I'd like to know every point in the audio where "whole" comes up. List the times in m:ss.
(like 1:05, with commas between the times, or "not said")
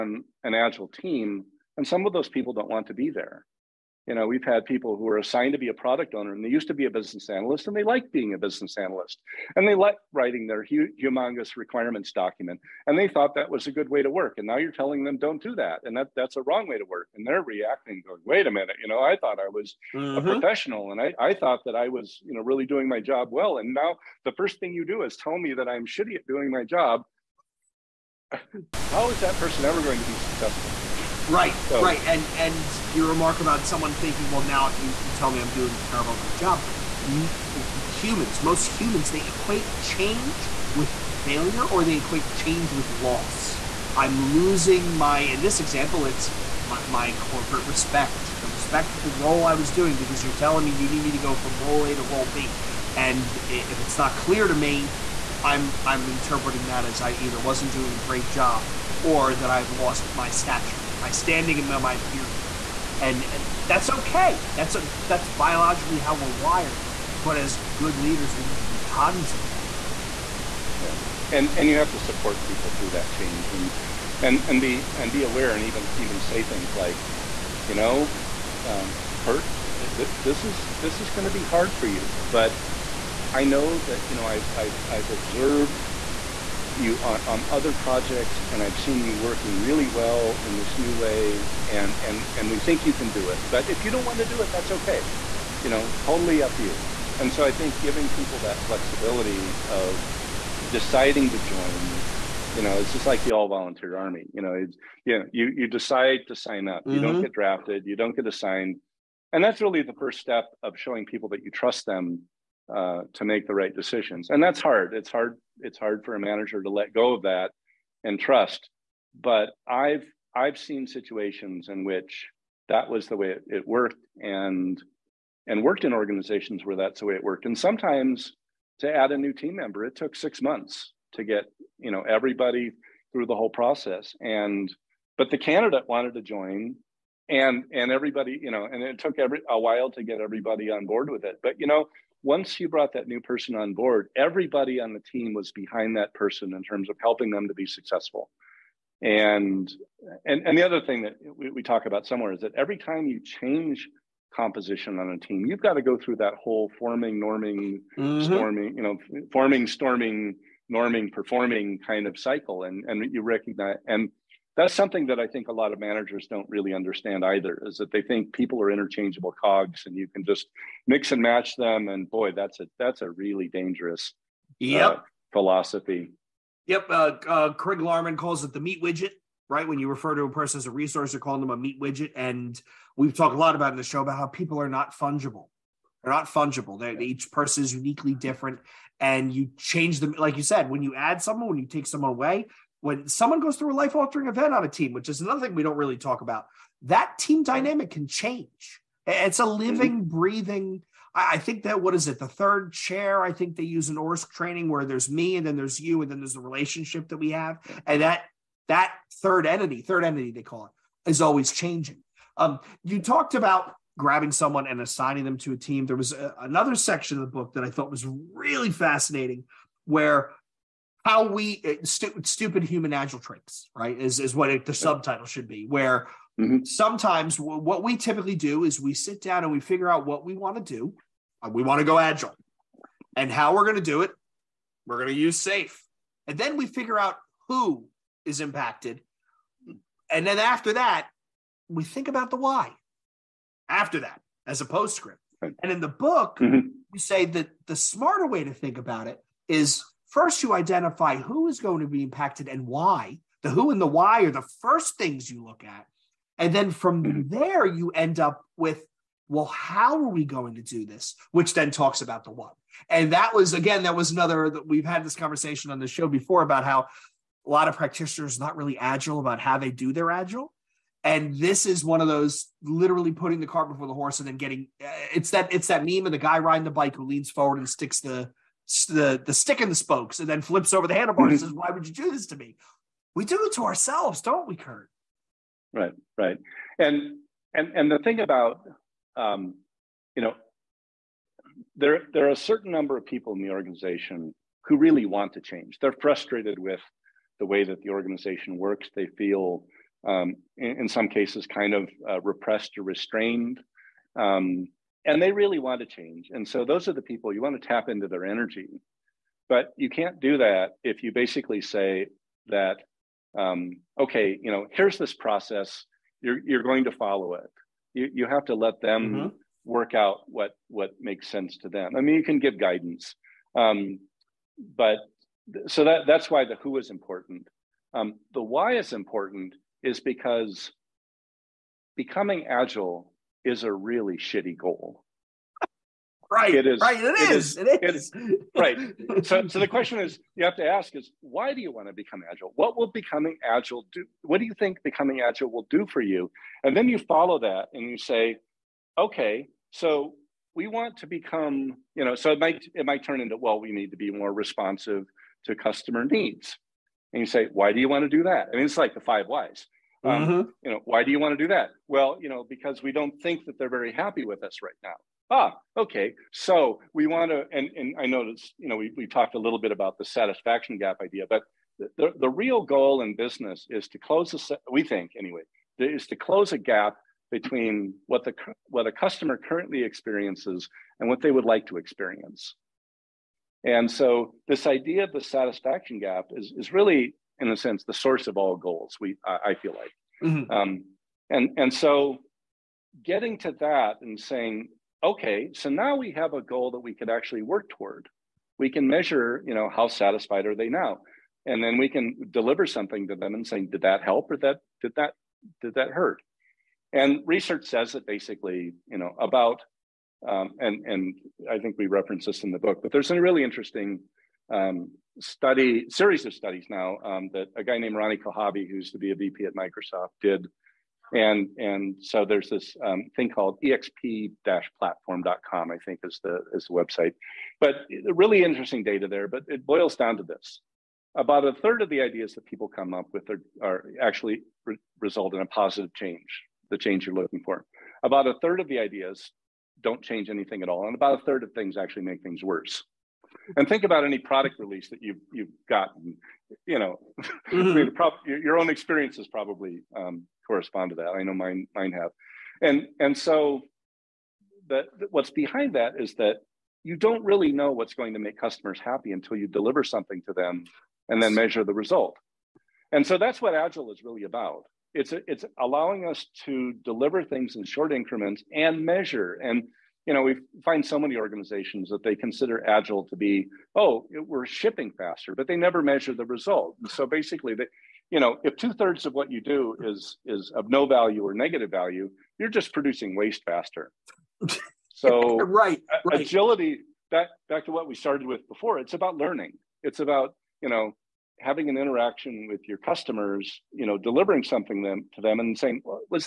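2:13, 2:36.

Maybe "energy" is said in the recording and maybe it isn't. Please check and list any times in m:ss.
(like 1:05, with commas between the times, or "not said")
5:08.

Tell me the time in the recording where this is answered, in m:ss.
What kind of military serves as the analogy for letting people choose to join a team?
1:43.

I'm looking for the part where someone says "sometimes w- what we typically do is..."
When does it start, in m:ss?
3:46.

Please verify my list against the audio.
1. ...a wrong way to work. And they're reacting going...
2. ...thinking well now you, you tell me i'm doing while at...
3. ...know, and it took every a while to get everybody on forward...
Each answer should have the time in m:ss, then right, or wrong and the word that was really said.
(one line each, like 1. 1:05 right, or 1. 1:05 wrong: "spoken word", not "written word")
1. 0:16 right
2. 0:33 wrong: "terrible", not "while"
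3. 2:18 wrong: "board", not "forward".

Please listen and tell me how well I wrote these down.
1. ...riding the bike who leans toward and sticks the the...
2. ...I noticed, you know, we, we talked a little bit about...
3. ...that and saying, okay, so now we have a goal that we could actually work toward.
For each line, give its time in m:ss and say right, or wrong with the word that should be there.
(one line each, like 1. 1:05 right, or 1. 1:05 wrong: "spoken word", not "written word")
1. 4:36 wrong: "forward", not "toward"
2. 6:07 right
3. 6:33 right.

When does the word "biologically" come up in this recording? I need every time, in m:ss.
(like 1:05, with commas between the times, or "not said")
1:05.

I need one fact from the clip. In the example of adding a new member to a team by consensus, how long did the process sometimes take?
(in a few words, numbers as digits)
6 months.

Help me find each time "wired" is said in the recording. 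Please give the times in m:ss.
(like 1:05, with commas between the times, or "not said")
1:06.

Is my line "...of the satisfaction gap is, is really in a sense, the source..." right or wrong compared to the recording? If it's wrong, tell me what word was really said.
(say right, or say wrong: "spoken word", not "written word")
right.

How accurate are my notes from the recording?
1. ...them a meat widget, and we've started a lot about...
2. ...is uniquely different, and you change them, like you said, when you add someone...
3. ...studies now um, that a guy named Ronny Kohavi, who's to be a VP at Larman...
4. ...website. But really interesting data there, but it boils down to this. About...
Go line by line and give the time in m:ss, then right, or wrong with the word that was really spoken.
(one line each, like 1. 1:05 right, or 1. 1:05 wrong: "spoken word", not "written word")
1. 3:01 wrong: "talked", not "started"
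2. 3:07 right
3. 6:56 wrong: "Microsoft", not "Larman"
4. 7:06 right.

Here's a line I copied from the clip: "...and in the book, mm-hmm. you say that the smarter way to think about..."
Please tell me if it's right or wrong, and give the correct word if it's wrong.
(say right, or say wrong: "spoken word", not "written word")
right.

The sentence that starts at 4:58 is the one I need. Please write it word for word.
They feel, um, in, in, some cases, kind of uh, repressed or restrained.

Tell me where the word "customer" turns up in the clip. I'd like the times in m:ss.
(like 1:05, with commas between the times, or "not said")
5:55, 6:18, 7:38, 8:12.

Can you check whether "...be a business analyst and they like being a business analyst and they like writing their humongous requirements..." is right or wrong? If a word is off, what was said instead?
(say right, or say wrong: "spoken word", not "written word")
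right.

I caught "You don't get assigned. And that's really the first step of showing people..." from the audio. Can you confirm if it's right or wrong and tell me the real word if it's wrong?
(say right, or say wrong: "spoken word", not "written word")
right.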